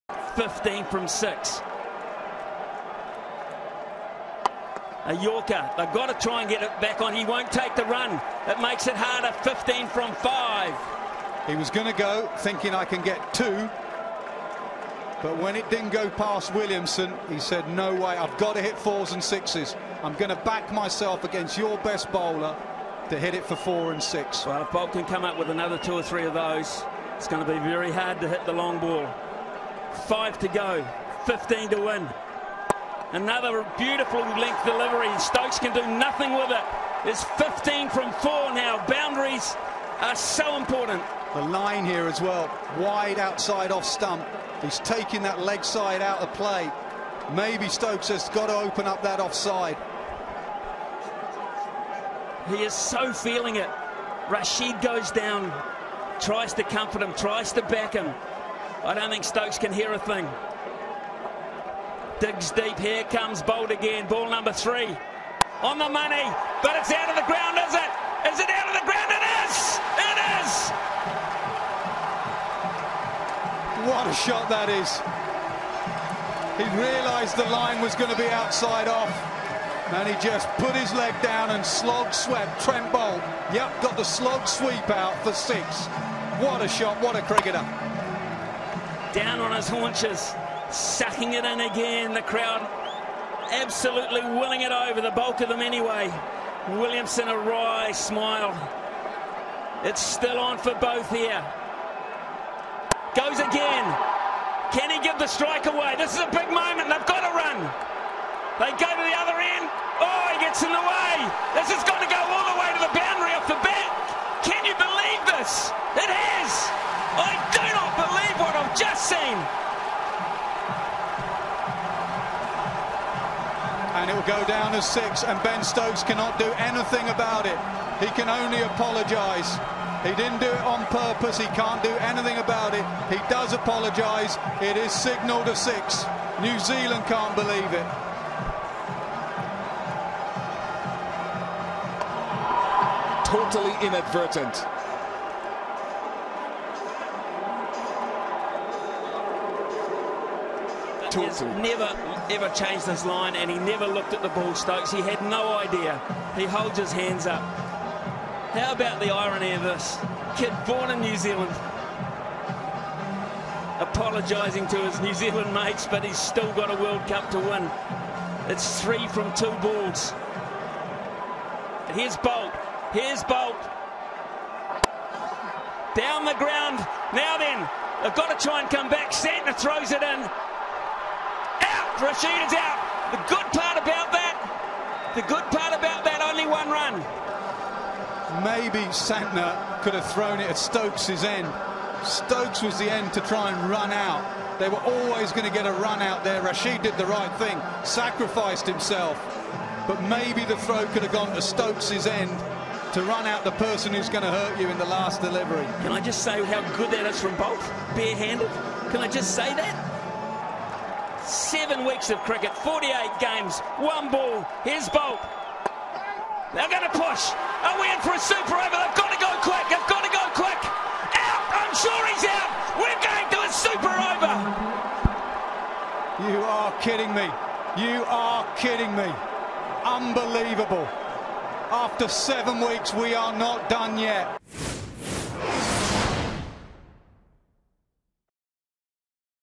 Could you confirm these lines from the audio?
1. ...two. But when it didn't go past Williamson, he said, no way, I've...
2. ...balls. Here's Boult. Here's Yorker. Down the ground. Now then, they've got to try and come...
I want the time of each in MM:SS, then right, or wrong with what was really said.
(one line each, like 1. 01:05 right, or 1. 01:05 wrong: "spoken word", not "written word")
1. 00:13 right
2. 02:49 wrong: "Boult", not "Yorker".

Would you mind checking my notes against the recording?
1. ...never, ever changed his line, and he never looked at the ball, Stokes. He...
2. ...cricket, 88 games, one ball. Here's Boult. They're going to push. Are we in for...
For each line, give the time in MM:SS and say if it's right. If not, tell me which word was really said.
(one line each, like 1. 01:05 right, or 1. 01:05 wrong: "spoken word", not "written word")
1. 02:31 right
2. 03:32 wrong: "48", not "88".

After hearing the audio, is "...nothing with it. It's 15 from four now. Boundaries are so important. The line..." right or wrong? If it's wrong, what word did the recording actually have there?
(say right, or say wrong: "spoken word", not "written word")
right.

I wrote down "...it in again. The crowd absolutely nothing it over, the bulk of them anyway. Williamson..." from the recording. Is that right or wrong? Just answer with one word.
wrong.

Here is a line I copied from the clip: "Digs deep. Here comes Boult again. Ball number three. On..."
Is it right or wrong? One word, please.
right.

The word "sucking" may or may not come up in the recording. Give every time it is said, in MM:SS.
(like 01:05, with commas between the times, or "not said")
01:30.